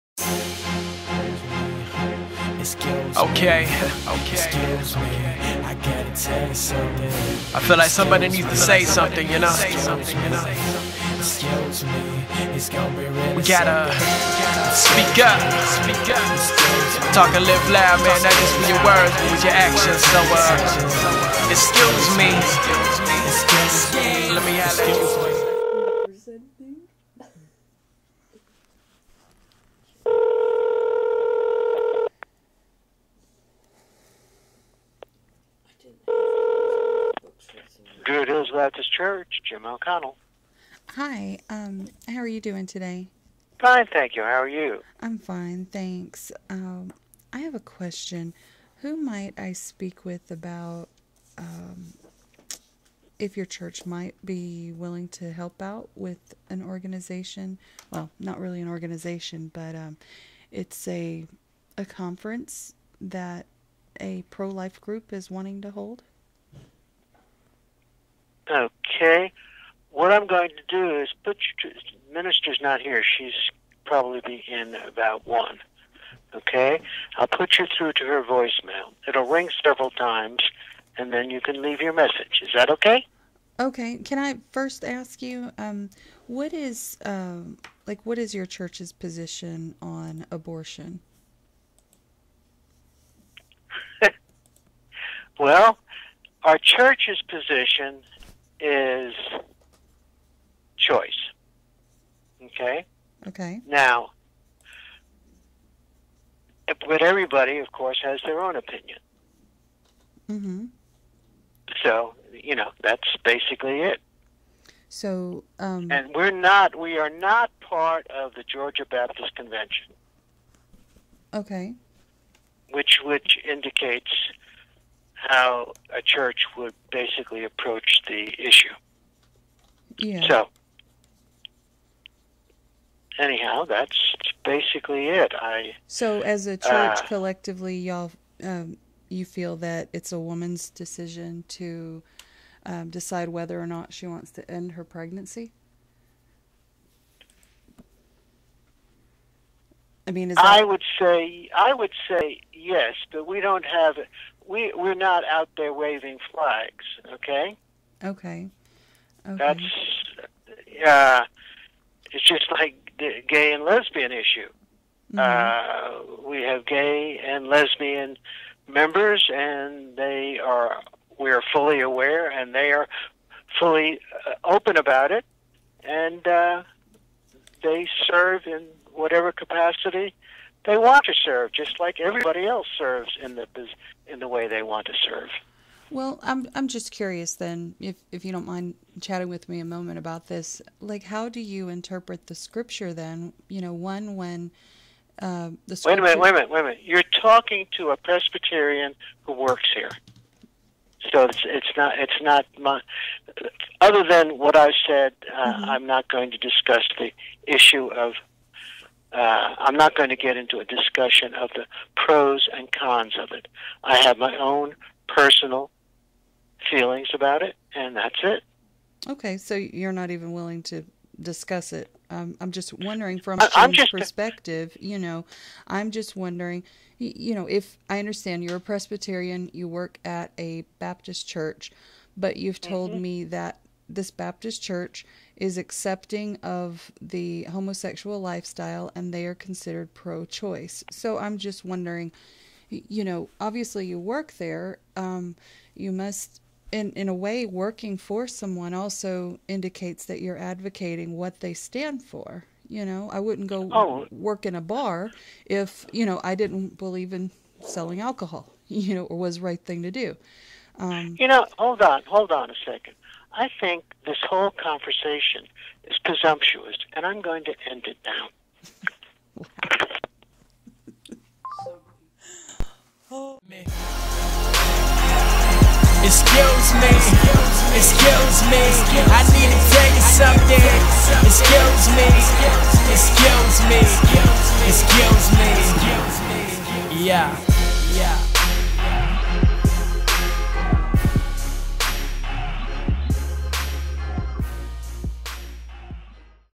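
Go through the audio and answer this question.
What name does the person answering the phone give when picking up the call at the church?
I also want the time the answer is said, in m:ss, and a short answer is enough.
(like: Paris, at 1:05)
Jim O'Connell, at 0:39.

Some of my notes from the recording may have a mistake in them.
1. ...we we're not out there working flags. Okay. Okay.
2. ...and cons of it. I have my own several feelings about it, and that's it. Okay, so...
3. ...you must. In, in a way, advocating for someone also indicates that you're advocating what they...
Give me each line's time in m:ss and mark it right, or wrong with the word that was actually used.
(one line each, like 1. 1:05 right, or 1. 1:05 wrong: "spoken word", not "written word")
1. 2:34 wrong: "waving", not "working"
2. 3:32 wrong: "personal", not "several"
3. 4:05 wrong: "working", not "advocating".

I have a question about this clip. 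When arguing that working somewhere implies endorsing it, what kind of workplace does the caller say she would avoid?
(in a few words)
a bar.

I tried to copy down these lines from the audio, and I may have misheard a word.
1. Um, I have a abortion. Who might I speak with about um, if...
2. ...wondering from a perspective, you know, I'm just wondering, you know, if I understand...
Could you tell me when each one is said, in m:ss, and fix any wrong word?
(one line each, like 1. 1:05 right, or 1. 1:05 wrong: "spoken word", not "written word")
1. 0:46 wrong: "question", not "abortion"
2. 3:42 right.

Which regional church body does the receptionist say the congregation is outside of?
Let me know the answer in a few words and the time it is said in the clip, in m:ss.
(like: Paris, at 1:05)
Georgia Baptist Convention, at 1:58.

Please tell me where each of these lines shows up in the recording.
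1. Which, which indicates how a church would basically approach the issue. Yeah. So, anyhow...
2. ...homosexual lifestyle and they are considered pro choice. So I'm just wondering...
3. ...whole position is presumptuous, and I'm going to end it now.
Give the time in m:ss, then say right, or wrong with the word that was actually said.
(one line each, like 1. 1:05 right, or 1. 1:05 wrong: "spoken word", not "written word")
1. 2:02 right
2. 3:57 right
3. 4:24 wrong: "conversation", not "position".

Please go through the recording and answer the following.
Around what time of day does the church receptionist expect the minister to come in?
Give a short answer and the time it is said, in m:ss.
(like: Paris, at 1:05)
about 1, at 1:14.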